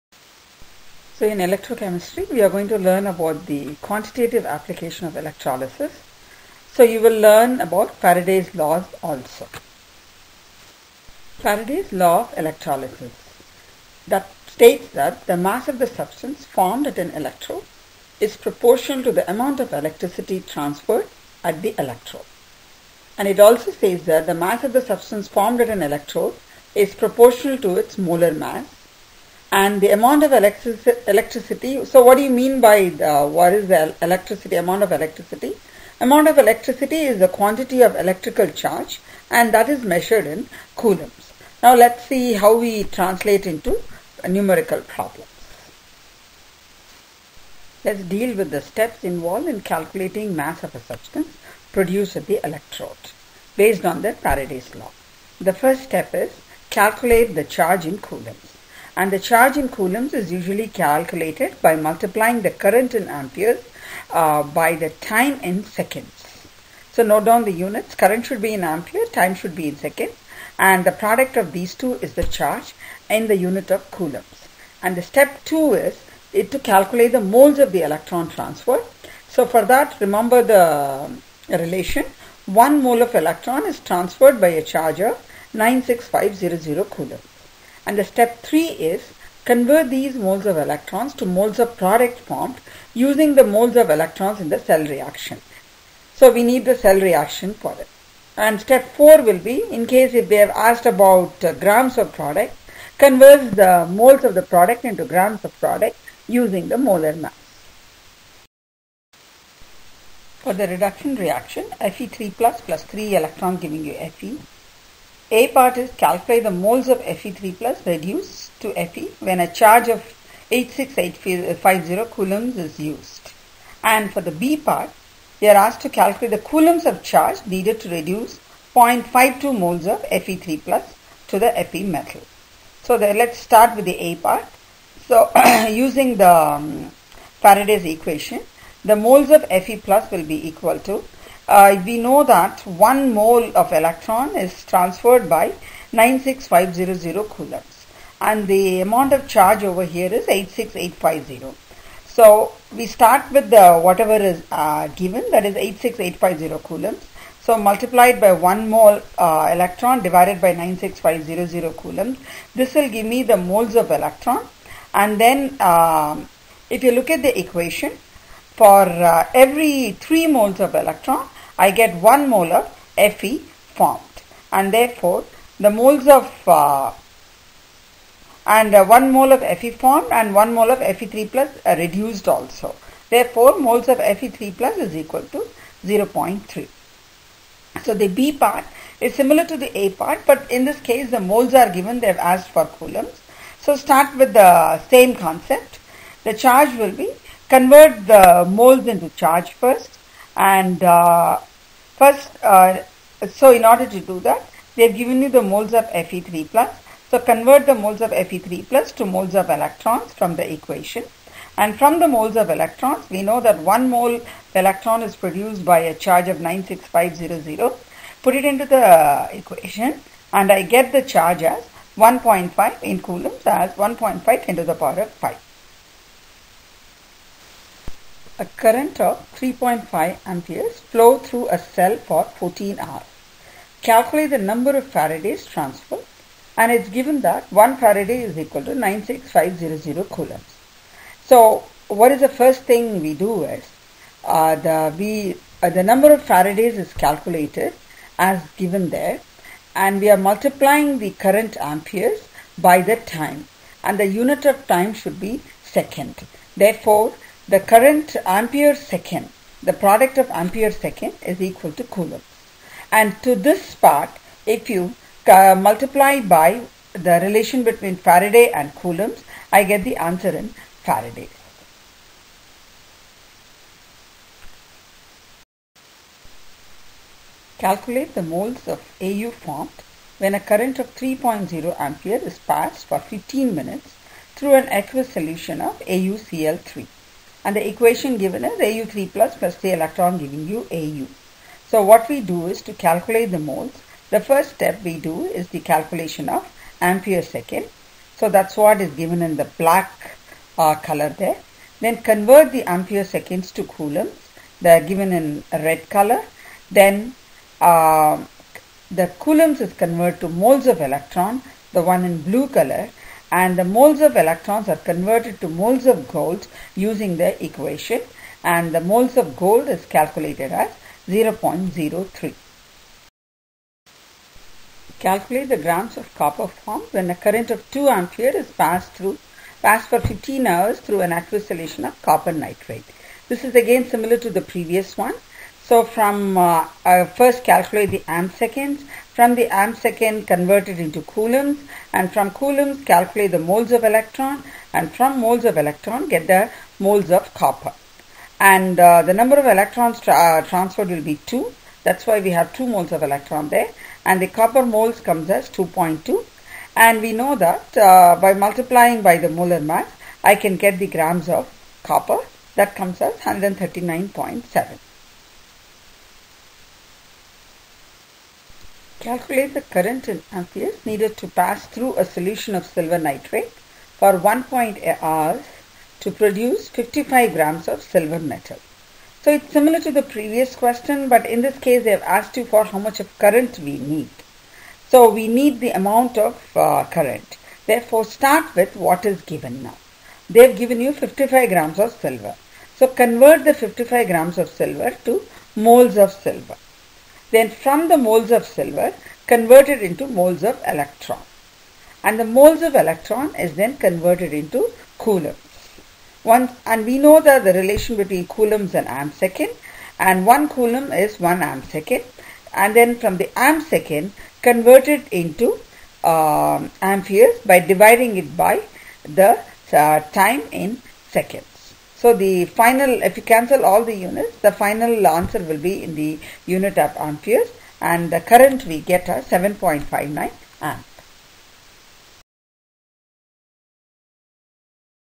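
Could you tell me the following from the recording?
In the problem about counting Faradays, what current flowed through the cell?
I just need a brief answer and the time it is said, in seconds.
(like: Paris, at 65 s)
3.5 amperes, at 229 s.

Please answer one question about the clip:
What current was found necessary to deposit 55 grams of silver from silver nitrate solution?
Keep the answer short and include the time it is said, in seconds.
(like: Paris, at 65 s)
7.59 amps, at 429 s.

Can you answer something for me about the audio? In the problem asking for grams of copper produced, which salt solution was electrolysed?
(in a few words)
copper nitrate.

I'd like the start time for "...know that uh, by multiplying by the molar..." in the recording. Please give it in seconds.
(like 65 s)
357 s.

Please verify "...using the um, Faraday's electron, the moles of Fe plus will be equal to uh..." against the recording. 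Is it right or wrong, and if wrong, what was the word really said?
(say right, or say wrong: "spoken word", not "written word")
wrong: "equation", not "electron".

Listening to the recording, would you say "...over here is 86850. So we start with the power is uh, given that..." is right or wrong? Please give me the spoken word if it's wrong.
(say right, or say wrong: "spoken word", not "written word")
wrong: "whatever", not "power".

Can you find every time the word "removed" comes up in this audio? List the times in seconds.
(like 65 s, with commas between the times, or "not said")
not said.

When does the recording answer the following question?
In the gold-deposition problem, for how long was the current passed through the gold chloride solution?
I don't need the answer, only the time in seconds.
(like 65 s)
282 s.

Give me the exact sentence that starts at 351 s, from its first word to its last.
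That's why we have 2 moles of electron there.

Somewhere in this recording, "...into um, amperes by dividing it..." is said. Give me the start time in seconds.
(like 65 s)
415 s.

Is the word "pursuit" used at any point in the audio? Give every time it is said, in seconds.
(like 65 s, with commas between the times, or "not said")
not said.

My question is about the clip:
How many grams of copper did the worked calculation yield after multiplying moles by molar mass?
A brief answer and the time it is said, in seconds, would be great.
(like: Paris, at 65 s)
139.7, at 363 s.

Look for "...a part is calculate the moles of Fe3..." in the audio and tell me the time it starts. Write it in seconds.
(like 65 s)
115 s.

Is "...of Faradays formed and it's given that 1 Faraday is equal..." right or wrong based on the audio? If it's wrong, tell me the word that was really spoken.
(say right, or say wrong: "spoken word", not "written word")
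wrong: "transferred", not "formed".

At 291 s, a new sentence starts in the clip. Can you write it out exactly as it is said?
So what we do is to calculate the moles.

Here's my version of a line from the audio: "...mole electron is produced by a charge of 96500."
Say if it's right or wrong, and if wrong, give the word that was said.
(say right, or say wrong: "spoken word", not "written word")
right.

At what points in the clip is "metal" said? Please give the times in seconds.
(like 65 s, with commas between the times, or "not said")
131 s, 378 s.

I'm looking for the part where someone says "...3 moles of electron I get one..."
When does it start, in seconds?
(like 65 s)
169 s.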